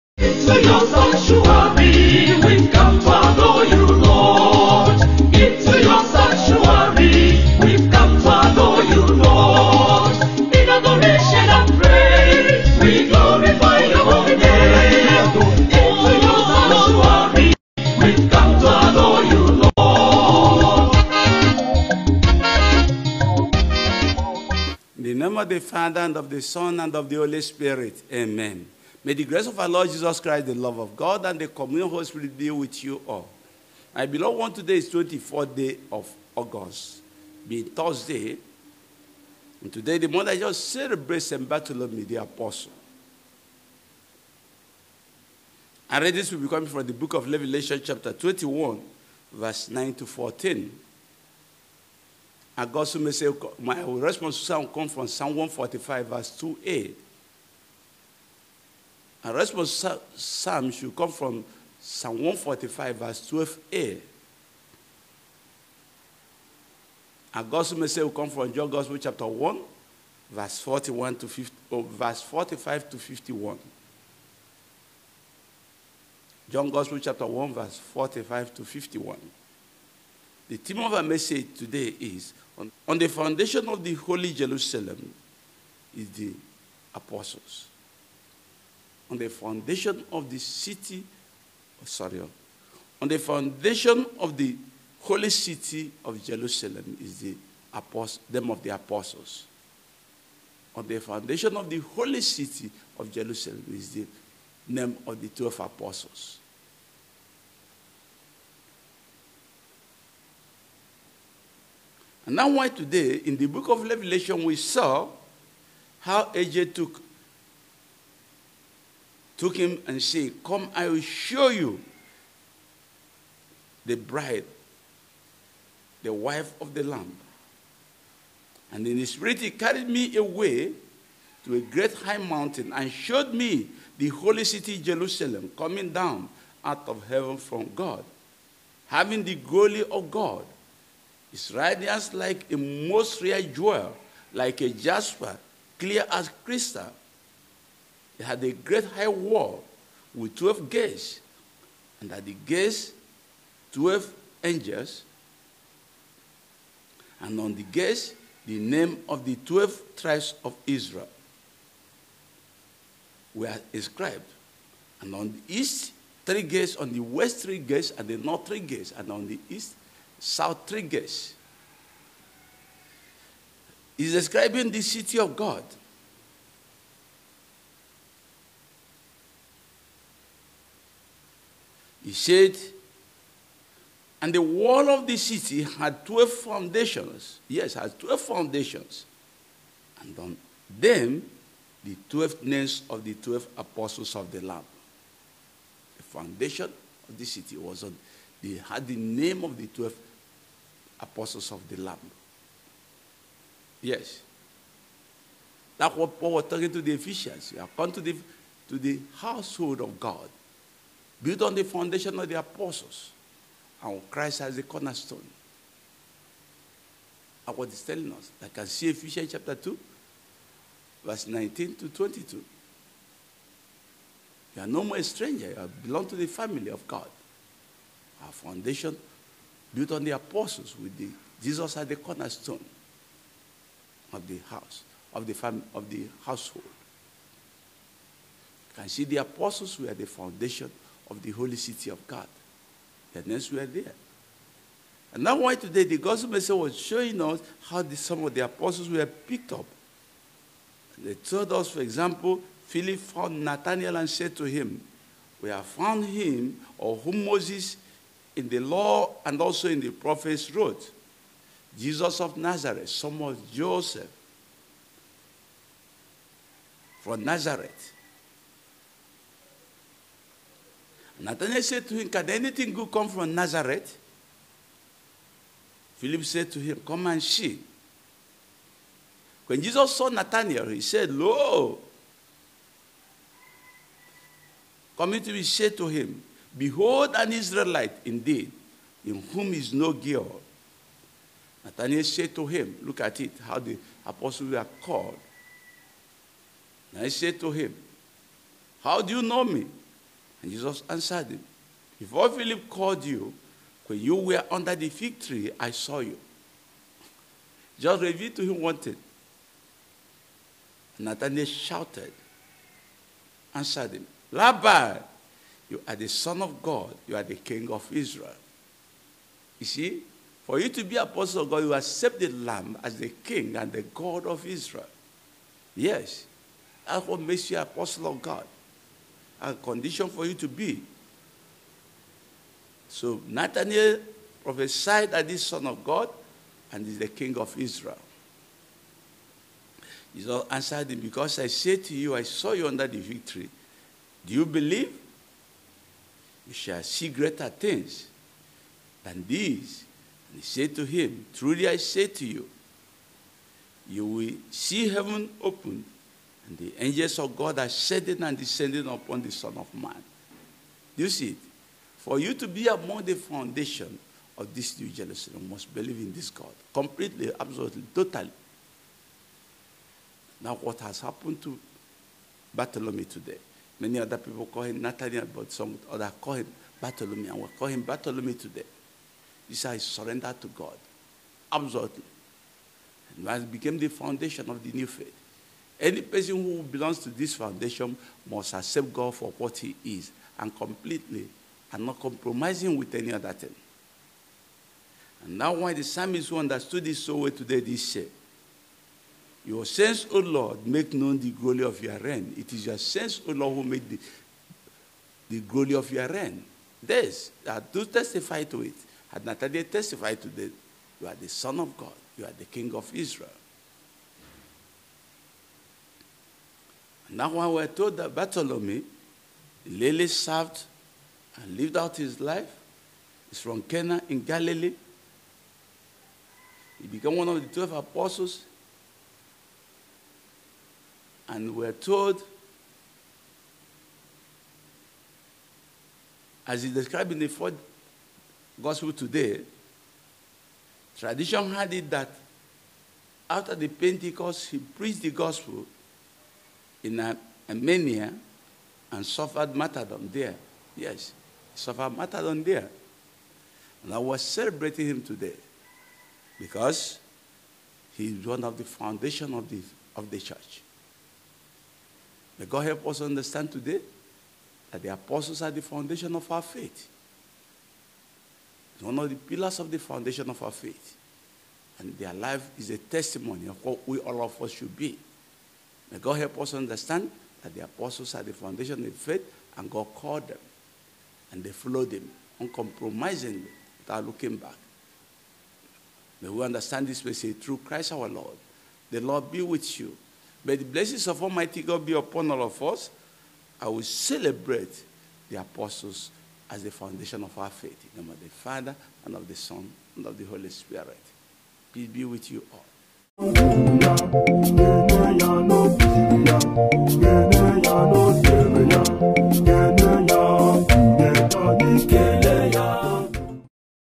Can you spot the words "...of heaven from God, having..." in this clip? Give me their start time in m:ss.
2:16.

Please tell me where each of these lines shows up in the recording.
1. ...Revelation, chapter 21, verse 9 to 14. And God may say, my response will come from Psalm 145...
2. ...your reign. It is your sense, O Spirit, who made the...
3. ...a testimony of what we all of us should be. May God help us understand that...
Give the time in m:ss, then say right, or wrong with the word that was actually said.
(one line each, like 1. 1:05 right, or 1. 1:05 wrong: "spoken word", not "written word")
1. 0:47 right
2. 6:41 wrong: "Lord", not "Spirit"
3. 7:52 right.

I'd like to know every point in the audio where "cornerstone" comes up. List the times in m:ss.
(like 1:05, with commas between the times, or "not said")
3:34, 3:51.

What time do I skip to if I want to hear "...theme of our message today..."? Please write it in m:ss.
1:20.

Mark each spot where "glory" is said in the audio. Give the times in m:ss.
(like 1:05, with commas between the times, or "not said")
2:19, 6:41, 6:45.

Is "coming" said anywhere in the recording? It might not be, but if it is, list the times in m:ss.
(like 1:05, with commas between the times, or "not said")
0:46, 2:15, 4:44.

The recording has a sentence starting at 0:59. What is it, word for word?
And response psalm should come from Psalm 145, verse 12a.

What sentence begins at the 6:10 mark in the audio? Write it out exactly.
Now, what has happened to Bartholomew today?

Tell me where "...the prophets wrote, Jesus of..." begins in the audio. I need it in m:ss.
4:19.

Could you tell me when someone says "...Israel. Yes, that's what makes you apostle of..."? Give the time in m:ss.
5:24.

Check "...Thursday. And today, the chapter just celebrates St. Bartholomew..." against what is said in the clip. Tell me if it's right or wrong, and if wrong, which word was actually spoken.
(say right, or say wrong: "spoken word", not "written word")
wrong: "mother", not "chapter".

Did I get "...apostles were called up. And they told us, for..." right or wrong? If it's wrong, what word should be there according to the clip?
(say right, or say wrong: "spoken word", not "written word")
wrong: "picked", not "called".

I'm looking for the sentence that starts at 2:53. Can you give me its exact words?
He's describing the city of God He said, and the wall of the city had 12 foundations.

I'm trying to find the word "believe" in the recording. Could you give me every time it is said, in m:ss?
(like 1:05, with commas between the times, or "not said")
5:44, 6:05.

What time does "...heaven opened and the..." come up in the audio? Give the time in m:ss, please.
5:54.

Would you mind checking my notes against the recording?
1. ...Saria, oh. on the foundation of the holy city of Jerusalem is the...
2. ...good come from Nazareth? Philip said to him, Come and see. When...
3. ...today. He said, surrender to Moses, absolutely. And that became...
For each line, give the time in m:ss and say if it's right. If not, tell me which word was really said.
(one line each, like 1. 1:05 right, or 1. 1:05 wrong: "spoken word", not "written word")
1. 1:31 right
2. 4:32 right
3. 6:18 wrong: "God", not "Moses".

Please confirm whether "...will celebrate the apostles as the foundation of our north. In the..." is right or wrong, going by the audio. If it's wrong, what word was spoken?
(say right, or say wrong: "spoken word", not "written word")
wrong: "faith", not "north".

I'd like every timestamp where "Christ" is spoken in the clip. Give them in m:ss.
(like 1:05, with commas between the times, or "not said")
0:30, 3:34, 8:07.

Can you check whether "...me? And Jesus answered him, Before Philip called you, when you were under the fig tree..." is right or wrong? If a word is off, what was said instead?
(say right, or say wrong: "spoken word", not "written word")
right.